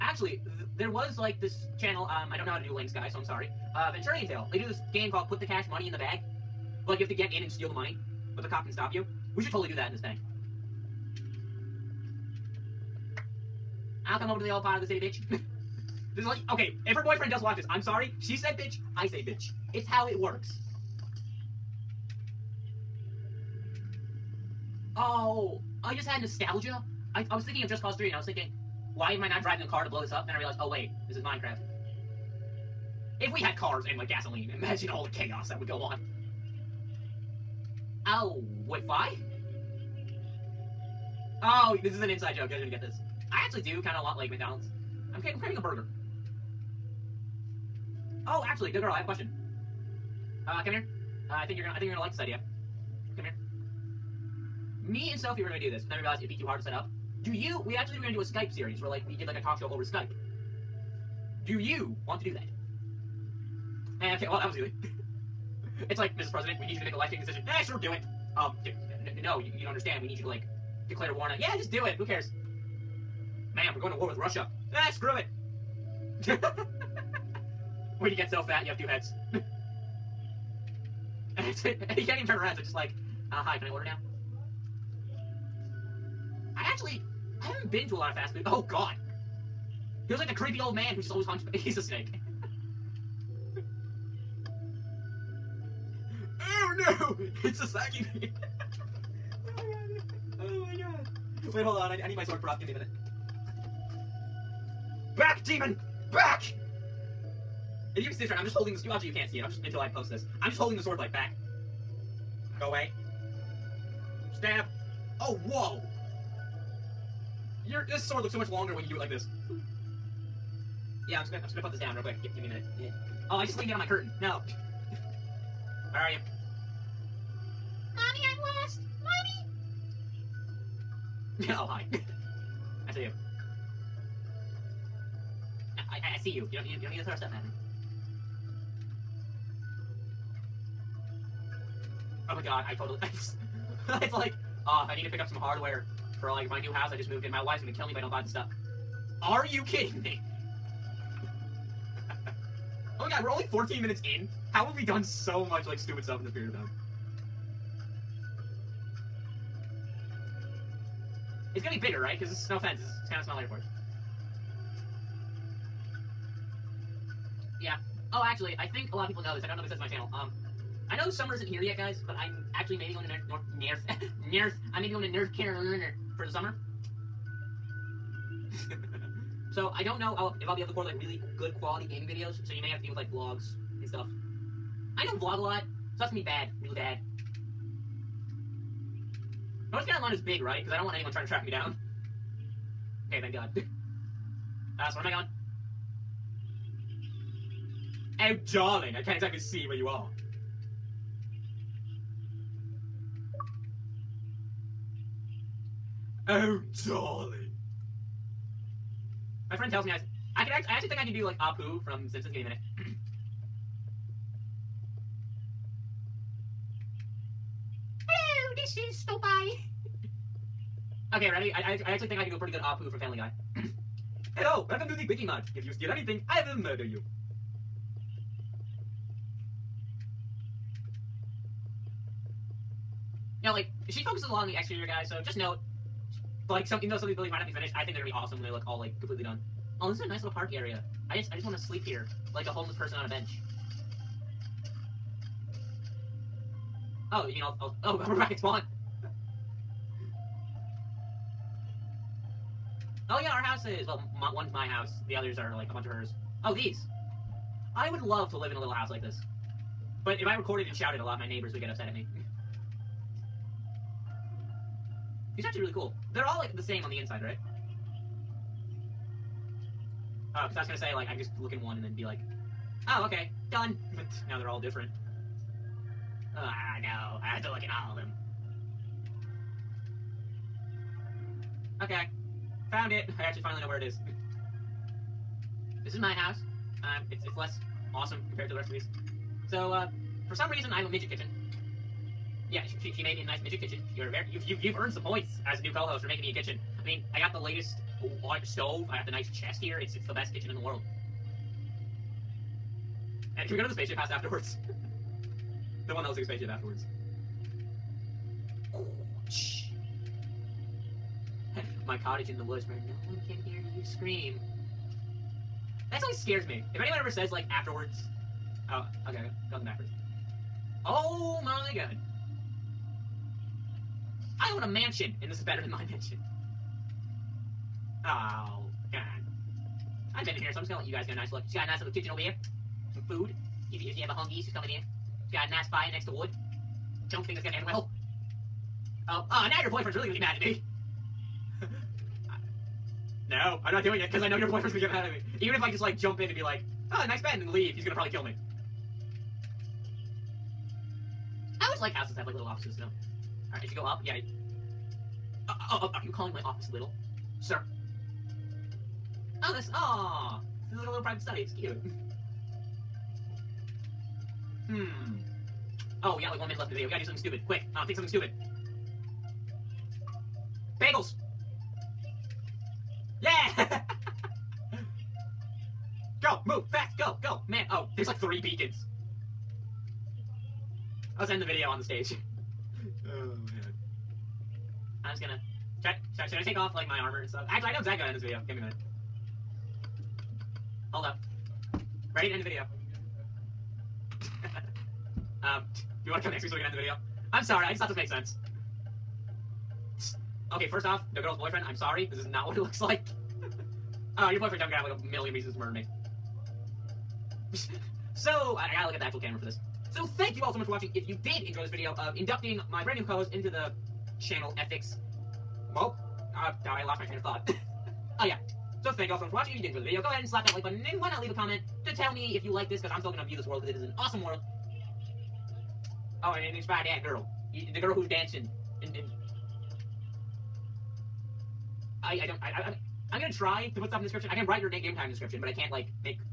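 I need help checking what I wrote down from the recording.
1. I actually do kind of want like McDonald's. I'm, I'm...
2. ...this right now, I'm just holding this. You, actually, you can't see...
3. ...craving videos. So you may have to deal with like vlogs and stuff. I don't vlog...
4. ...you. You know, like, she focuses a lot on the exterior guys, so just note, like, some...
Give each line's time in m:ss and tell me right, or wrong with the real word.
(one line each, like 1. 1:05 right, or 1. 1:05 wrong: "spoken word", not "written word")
1. 0:43 right
2. 1:48 right
3. 3:01 wrong: "gaming", not "craving"
4. 3:46 right.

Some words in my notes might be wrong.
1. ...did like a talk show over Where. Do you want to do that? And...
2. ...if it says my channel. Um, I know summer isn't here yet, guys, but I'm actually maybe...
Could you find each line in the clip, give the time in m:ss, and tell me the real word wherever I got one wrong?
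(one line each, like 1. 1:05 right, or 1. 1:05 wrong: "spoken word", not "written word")
1. 0:59 wrong: "Skype", not "Where"
2. 2:49 right.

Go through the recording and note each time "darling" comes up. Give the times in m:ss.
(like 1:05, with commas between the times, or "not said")
3:18, 3:26.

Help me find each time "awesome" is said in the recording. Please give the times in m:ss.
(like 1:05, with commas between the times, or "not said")
3:58, 4:47, 7:03.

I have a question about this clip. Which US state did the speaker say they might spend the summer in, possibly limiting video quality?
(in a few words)
North Carolina.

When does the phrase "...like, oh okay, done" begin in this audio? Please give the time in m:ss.
4:32.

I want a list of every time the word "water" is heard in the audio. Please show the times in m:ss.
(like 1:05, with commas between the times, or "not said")
not said.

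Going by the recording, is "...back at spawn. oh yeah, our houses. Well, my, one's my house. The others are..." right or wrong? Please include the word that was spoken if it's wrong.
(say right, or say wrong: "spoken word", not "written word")
right.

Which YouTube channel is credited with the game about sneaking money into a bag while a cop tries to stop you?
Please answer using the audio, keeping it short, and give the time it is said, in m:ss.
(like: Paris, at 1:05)
Venturian Tale, at 0:03.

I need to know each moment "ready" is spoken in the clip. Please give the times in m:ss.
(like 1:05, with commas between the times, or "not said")
3:41, 6:32.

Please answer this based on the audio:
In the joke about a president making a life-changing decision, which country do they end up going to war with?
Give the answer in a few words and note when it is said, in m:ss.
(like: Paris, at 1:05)
Russia, at 1:14.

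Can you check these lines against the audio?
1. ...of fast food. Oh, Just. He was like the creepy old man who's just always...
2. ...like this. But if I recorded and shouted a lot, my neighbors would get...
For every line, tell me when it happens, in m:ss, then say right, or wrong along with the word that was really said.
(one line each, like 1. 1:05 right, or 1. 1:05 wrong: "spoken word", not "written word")
1. 1:28 wrong: "God", not "Just"
2. 4:18 right.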